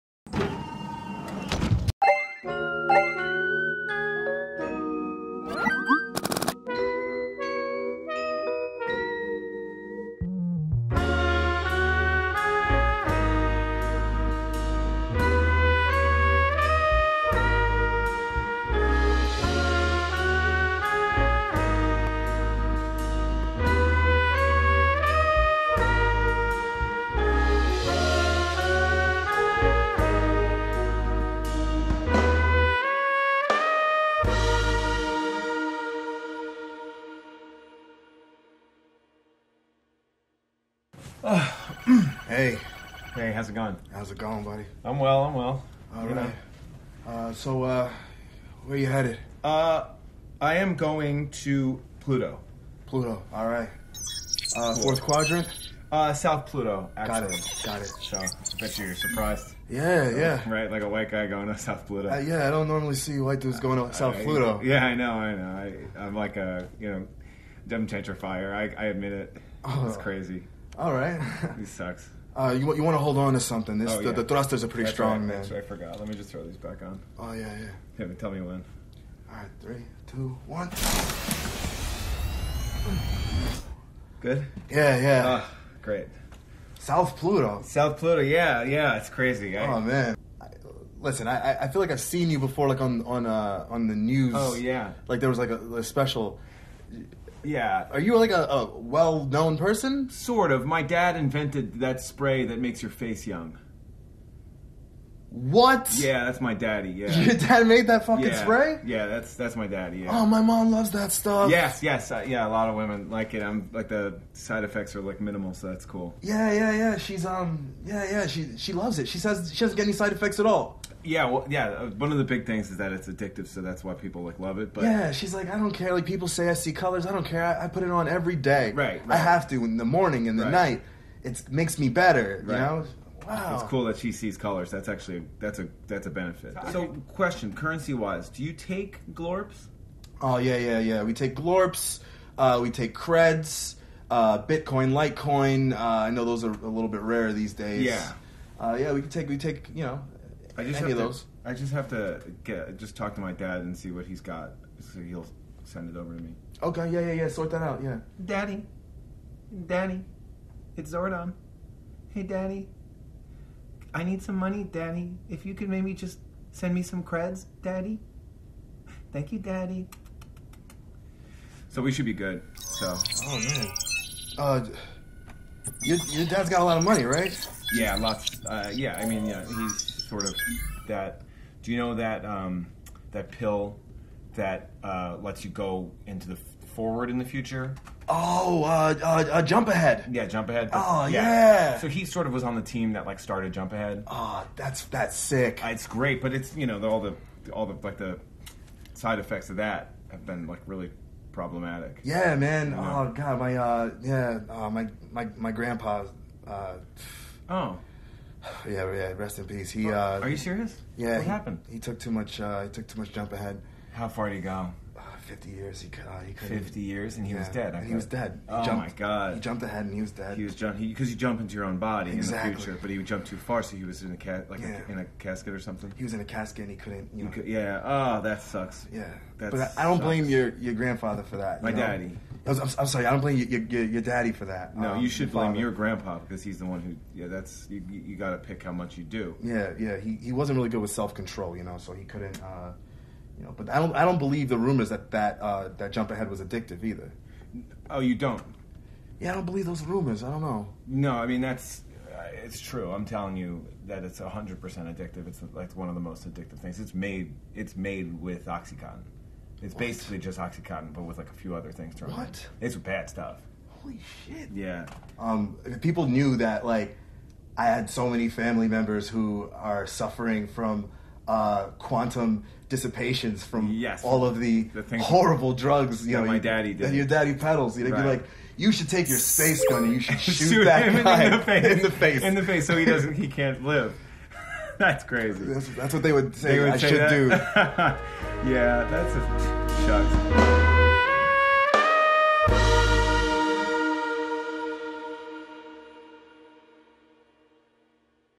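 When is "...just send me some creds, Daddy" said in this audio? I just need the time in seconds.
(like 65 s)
165 s.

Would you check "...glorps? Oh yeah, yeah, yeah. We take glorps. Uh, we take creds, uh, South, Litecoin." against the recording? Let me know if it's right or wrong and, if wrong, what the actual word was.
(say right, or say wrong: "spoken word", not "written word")
wrong: "Bitcoin", not "South".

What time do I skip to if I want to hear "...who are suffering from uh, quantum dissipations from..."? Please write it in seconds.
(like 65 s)
269 s.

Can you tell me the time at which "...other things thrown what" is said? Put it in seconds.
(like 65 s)
261 s.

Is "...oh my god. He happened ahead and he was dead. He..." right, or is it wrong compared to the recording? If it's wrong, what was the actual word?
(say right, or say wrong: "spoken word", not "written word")
wrong: "jumped", not "happened".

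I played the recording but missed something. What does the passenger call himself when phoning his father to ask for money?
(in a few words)
Zordon.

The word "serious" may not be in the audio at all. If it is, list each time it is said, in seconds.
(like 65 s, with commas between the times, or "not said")
210 s.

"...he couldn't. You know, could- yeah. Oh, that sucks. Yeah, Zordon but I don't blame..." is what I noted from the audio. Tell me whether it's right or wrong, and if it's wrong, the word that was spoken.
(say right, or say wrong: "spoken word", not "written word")
wrong: "That", not "Zordon".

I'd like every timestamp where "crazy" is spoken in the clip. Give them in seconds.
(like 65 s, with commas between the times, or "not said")
69 s, 89 s, 285 s.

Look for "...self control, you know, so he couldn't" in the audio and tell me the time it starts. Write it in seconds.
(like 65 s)
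240 s.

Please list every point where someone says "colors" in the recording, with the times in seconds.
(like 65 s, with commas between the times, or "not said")
126 s, 134 s.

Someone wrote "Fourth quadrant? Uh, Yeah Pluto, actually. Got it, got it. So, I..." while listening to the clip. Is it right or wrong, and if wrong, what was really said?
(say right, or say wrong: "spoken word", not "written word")
wrong: "South", not "Yeah".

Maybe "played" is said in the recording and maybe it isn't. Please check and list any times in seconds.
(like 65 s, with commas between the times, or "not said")
not said.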